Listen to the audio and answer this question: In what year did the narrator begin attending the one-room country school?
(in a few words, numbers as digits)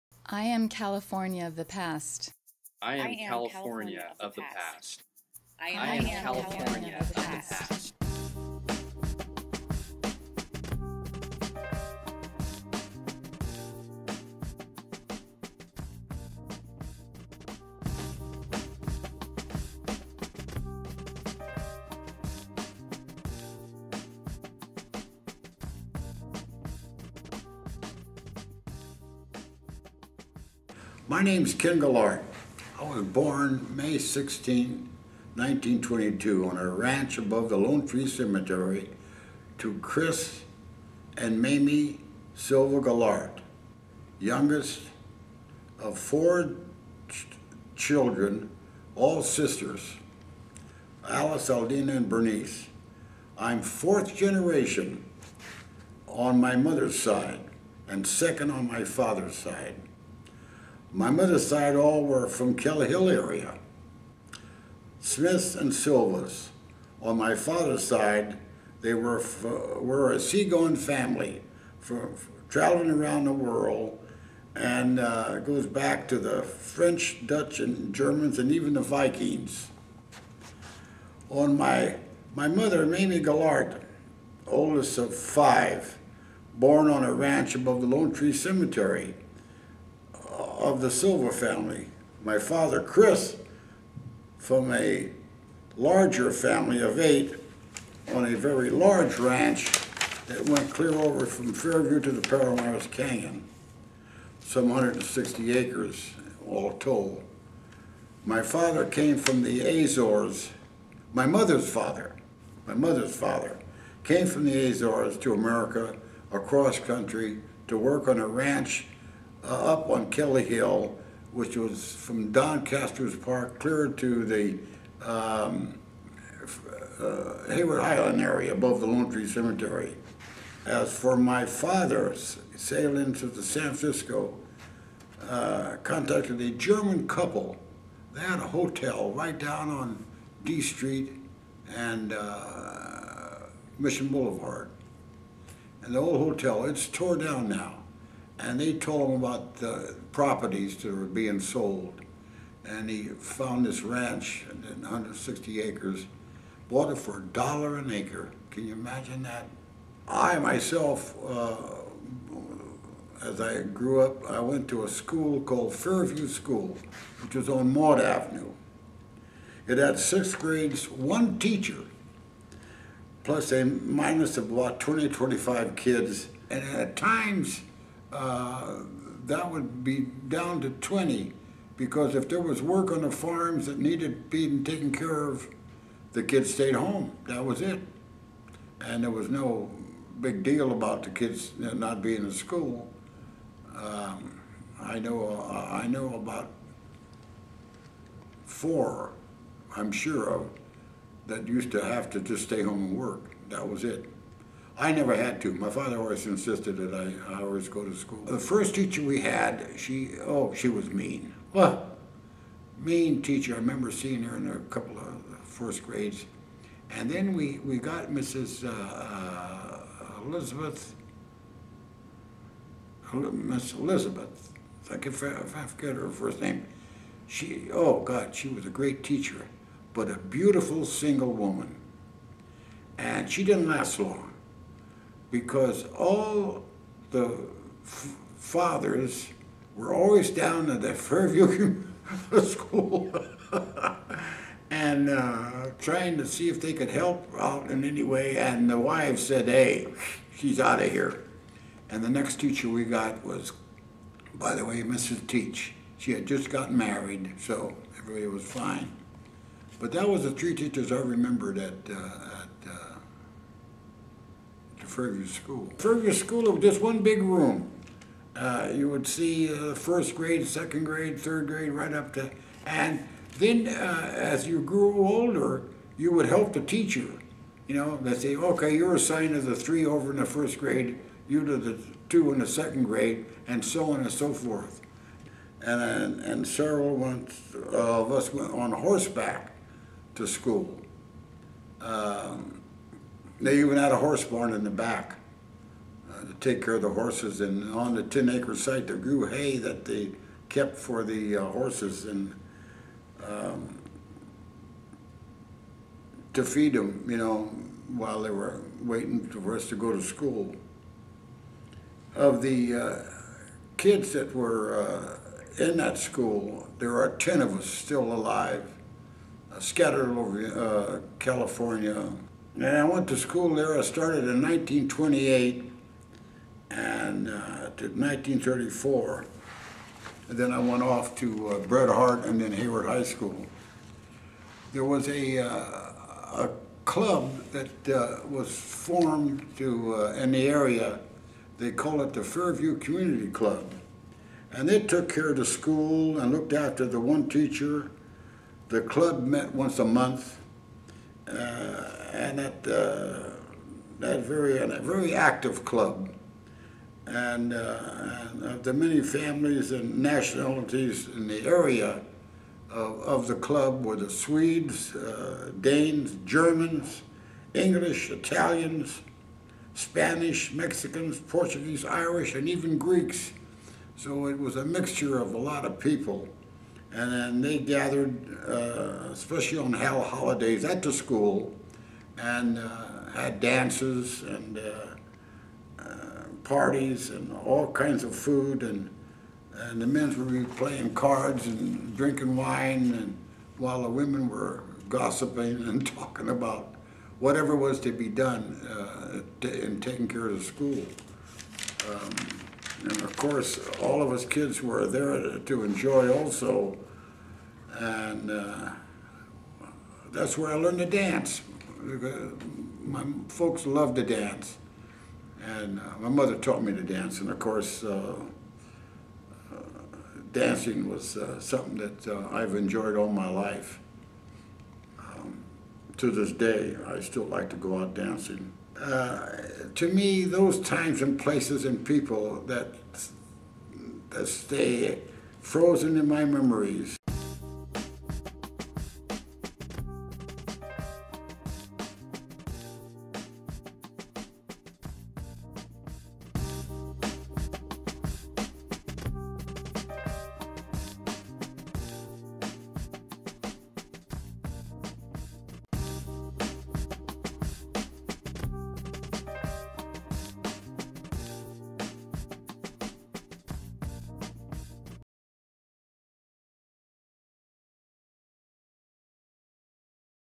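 1928.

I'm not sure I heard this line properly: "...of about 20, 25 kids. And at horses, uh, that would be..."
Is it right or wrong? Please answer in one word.
wrong.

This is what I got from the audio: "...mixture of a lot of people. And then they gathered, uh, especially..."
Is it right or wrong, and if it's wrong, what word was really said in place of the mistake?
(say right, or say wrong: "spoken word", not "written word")
right.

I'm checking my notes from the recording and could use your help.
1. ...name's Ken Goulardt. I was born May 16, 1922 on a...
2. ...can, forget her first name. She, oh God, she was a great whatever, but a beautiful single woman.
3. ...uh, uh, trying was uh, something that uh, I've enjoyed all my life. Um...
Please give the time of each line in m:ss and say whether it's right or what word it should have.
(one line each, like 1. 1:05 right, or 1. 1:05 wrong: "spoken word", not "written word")
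1. 0:31 right
2. 3:44 wrong: "teacher", not "whatever"
3. 6:57 wrong: "dancing", not "trying".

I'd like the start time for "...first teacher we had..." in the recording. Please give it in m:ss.
3:28.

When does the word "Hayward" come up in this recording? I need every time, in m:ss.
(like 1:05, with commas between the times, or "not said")
2:07, 5:32.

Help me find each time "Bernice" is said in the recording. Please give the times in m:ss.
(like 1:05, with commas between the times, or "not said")
0:52.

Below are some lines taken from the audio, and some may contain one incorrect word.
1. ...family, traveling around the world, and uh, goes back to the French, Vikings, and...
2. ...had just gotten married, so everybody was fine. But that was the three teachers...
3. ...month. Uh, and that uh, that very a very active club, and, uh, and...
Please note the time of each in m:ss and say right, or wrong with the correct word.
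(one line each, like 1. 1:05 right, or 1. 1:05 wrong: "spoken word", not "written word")
1. 1:10 wrong: "Dutch", not "Vikings"
2. 4:16 right
3. 5:49 right.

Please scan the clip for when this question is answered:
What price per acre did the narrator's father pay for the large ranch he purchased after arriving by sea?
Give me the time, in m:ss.
2:37.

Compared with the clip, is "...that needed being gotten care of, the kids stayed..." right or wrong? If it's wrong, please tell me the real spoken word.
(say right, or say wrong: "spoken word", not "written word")
wrong: "taken", not "gotten".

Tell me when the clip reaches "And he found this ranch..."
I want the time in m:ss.
2:32.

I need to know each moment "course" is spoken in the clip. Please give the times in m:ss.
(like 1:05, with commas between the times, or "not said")
6:43, 6:57.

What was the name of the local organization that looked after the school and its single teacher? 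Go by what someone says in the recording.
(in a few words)
Fairview Community Club.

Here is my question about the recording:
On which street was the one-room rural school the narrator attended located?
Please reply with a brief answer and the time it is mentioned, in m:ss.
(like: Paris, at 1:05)
Maud Avenue, at 2:47.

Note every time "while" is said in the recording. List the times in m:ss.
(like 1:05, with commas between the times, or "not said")
5:07, 6:33.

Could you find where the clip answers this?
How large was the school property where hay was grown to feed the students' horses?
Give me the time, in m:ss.
4:58.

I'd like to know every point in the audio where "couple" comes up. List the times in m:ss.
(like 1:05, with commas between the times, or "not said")
2:17, 3:34.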